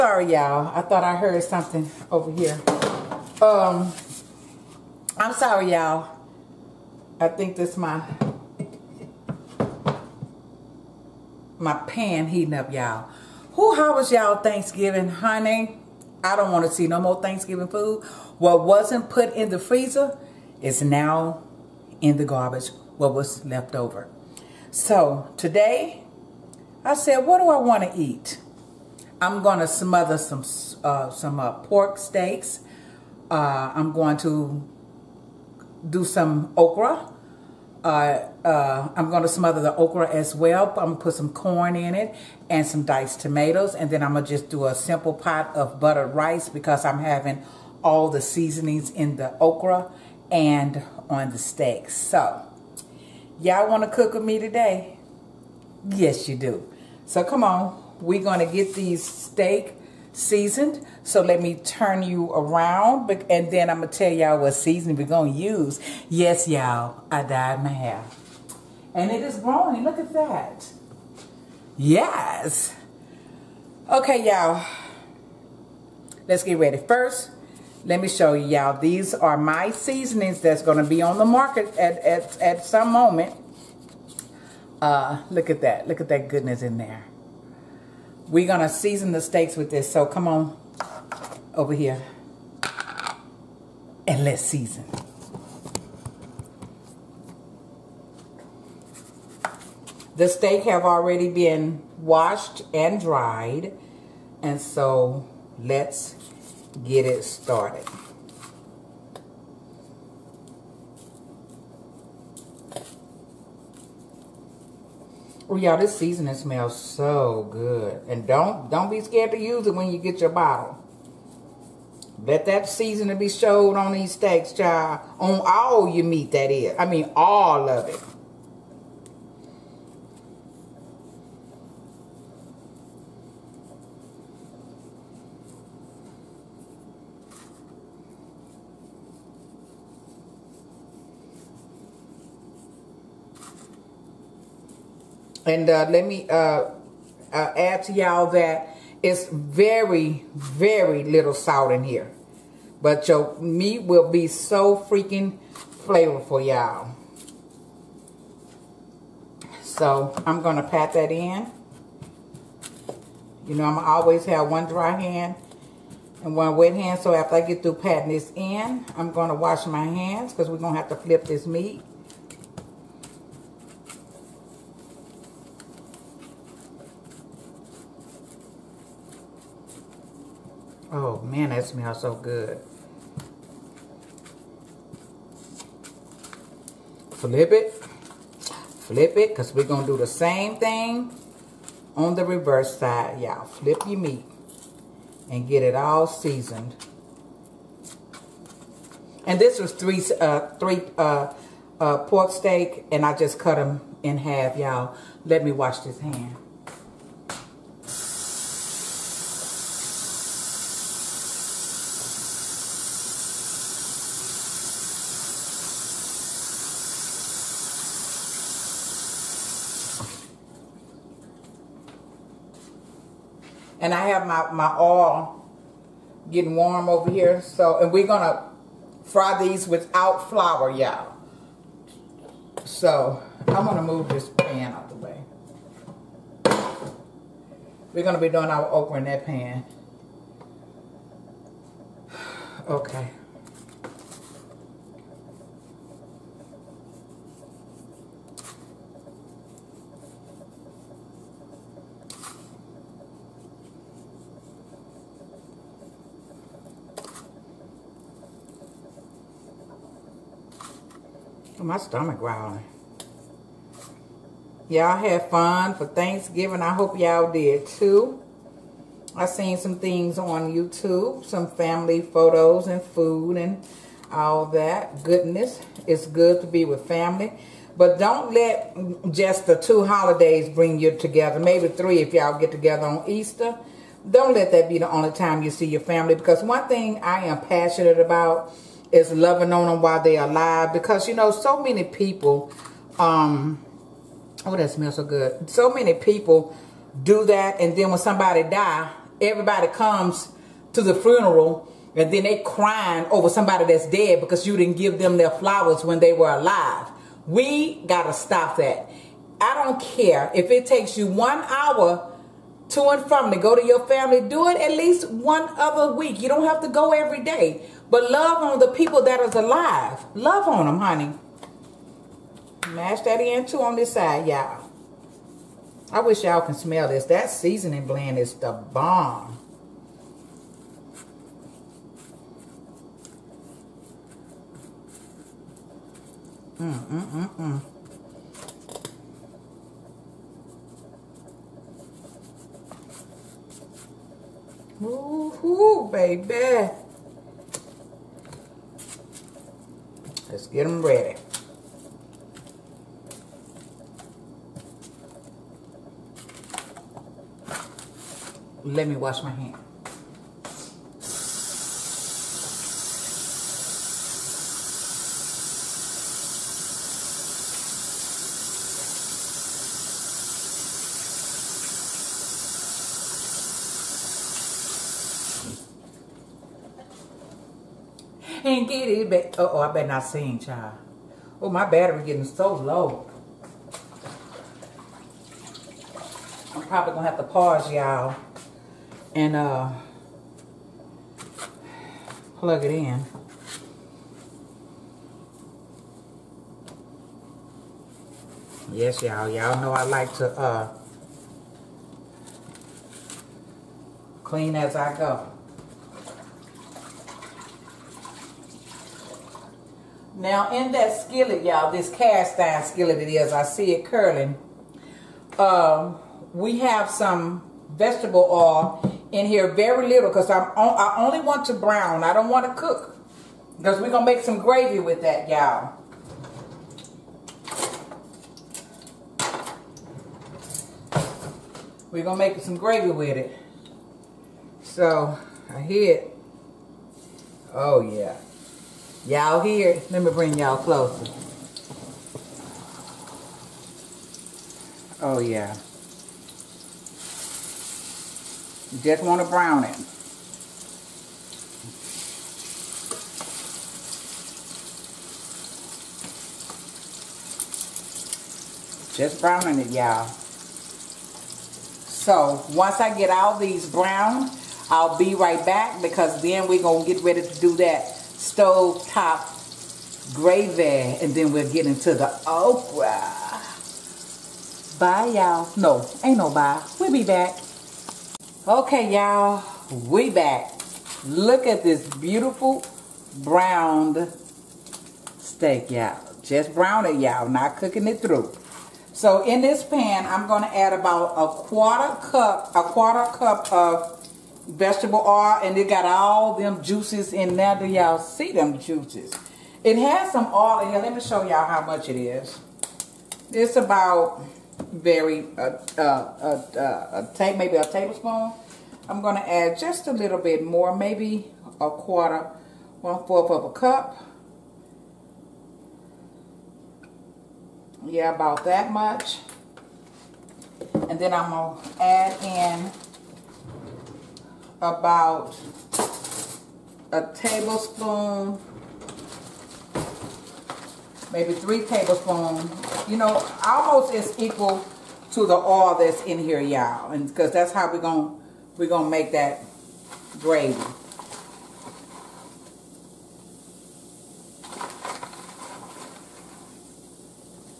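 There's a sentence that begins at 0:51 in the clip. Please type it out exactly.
So, y'all want to cook with me today?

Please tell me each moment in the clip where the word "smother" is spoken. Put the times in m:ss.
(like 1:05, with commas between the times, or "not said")
0:29, 0:39.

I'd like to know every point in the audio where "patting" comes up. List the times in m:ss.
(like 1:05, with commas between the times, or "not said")
2:47.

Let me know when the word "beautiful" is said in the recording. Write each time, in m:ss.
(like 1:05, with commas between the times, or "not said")
8:01.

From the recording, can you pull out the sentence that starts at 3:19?
And this was three, uh, three uh, uh, pork steak and I just cut them in half, y'all.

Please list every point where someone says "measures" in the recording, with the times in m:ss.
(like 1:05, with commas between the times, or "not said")
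not said.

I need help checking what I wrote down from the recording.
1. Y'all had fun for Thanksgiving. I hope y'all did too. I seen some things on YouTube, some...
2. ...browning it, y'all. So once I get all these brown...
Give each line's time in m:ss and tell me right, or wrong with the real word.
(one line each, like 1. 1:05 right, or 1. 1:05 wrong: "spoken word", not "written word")
1. 4:24 right
2. 7:39 right.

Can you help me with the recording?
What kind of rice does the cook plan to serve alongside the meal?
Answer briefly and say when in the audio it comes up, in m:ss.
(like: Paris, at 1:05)
buttered rice, at 0:45.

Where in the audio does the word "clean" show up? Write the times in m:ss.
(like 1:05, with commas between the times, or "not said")
6:44.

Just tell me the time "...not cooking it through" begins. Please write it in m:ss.
8:07.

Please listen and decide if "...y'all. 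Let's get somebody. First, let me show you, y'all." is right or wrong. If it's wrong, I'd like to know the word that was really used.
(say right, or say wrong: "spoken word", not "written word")
wrong: "ready", not "somebody".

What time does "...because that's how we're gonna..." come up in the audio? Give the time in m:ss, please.
8:57.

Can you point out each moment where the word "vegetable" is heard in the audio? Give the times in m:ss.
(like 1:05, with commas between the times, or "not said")
6:57, 8:14.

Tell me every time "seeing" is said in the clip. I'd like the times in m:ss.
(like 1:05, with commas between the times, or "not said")
not said.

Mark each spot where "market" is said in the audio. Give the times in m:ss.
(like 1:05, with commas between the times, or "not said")
1:21.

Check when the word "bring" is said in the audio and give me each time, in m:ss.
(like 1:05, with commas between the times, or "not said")
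4:40, 7:20.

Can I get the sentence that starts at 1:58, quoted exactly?
And don't don't be scared to use it when you get your bottle.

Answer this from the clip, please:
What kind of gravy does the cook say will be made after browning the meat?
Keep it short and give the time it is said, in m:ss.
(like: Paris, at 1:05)
stove top gravy, at 7:48.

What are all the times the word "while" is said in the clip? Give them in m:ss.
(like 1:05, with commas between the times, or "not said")
4:49.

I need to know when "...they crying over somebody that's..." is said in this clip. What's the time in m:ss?
5:02.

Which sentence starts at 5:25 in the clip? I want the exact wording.
I wish y'all can smell this.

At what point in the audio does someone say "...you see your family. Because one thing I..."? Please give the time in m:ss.
4:45.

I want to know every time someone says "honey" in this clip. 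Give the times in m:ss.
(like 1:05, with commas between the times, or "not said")
0:15, 5:20.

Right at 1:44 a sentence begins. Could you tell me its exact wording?
And so let's get it started.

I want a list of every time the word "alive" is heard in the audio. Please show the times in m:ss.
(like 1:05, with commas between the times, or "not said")
4:50, 5:06, 5:19.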